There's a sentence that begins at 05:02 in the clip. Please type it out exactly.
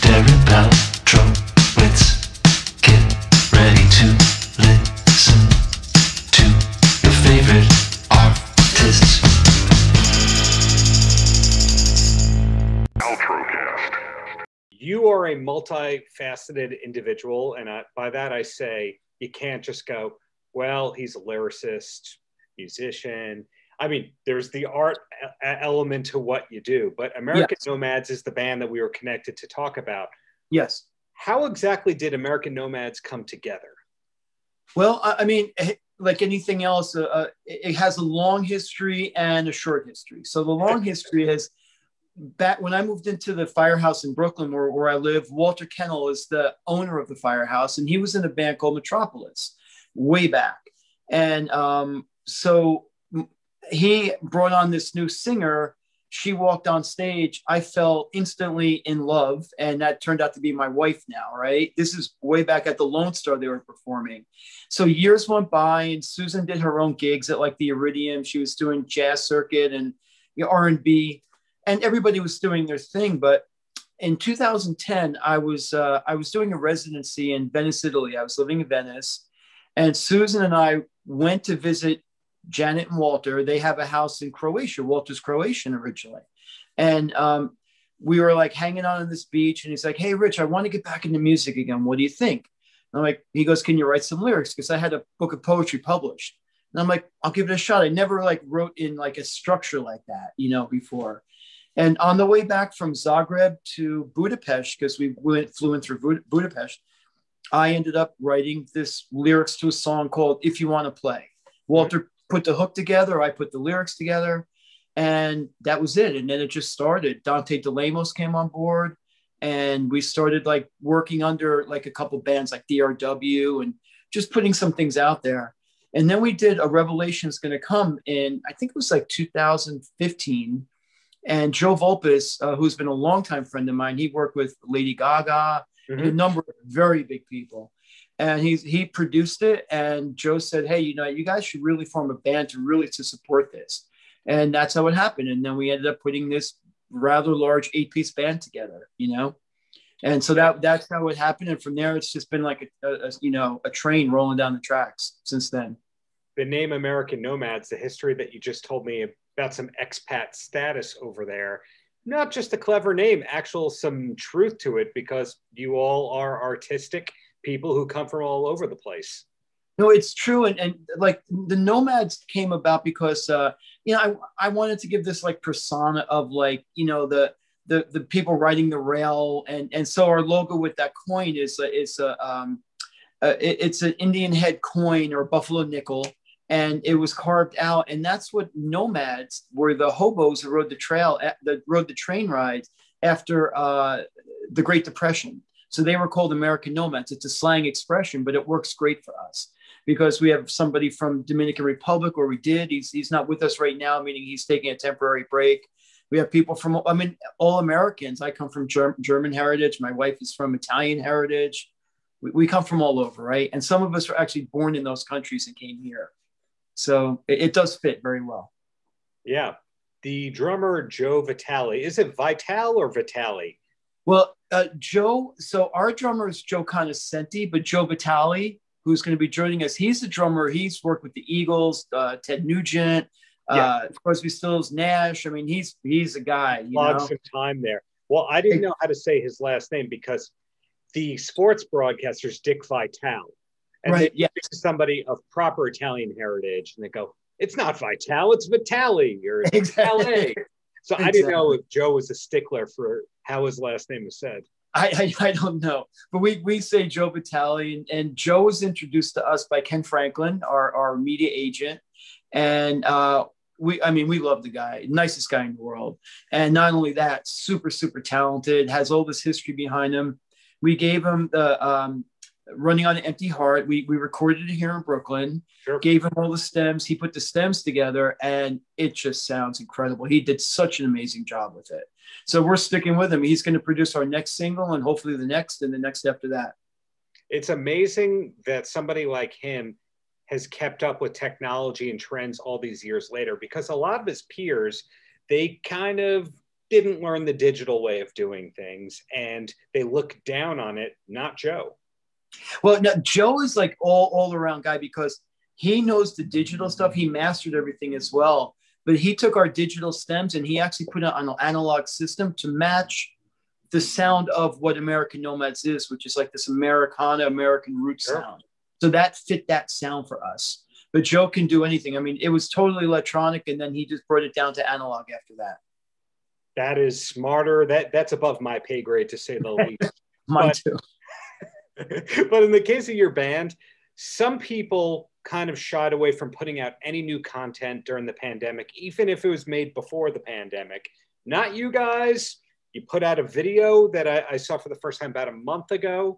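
Well, now Joe is like all all around guy because he knows the digital stuff.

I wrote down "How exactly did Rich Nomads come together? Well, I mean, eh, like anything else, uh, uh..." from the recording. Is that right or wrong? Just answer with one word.
wrong.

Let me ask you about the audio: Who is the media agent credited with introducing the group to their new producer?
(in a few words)
Ken Franklin.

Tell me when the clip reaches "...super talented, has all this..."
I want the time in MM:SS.
04:27.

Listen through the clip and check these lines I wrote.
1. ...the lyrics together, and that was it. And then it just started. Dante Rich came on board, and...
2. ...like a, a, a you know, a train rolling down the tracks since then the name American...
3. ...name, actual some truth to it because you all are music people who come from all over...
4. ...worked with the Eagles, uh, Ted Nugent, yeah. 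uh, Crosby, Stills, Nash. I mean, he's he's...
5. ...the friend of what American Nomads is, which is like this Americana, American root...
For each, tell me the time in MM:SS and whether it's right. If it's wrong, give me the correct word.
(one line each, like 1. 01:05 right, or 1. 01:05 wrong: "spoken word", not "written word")
1. 01:53 wrong: "DeLamos", not "Rich"
2. 02:32 right
3. 02:42 wrong: "artistic", not "music"
4. 03:50 right
5. 05:13 wrong: "sound", not "friend".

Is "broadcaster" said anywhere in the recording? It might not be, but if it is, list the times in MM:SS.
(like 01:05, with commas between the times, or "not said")
04:01.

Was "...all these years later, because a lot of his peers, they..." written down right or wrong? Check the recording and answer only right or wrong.
right.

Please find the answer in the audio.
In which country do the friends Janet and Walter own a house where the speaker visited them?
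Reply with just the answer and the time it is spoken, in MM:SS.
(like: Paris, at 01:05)
Croatia, at 01:24.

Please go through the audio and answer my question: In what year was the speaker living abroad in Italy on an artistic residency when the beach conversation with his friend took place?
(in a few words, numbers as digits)
2010.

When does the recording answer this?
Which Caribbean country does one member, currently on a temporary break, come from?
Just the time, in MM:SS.
03:21.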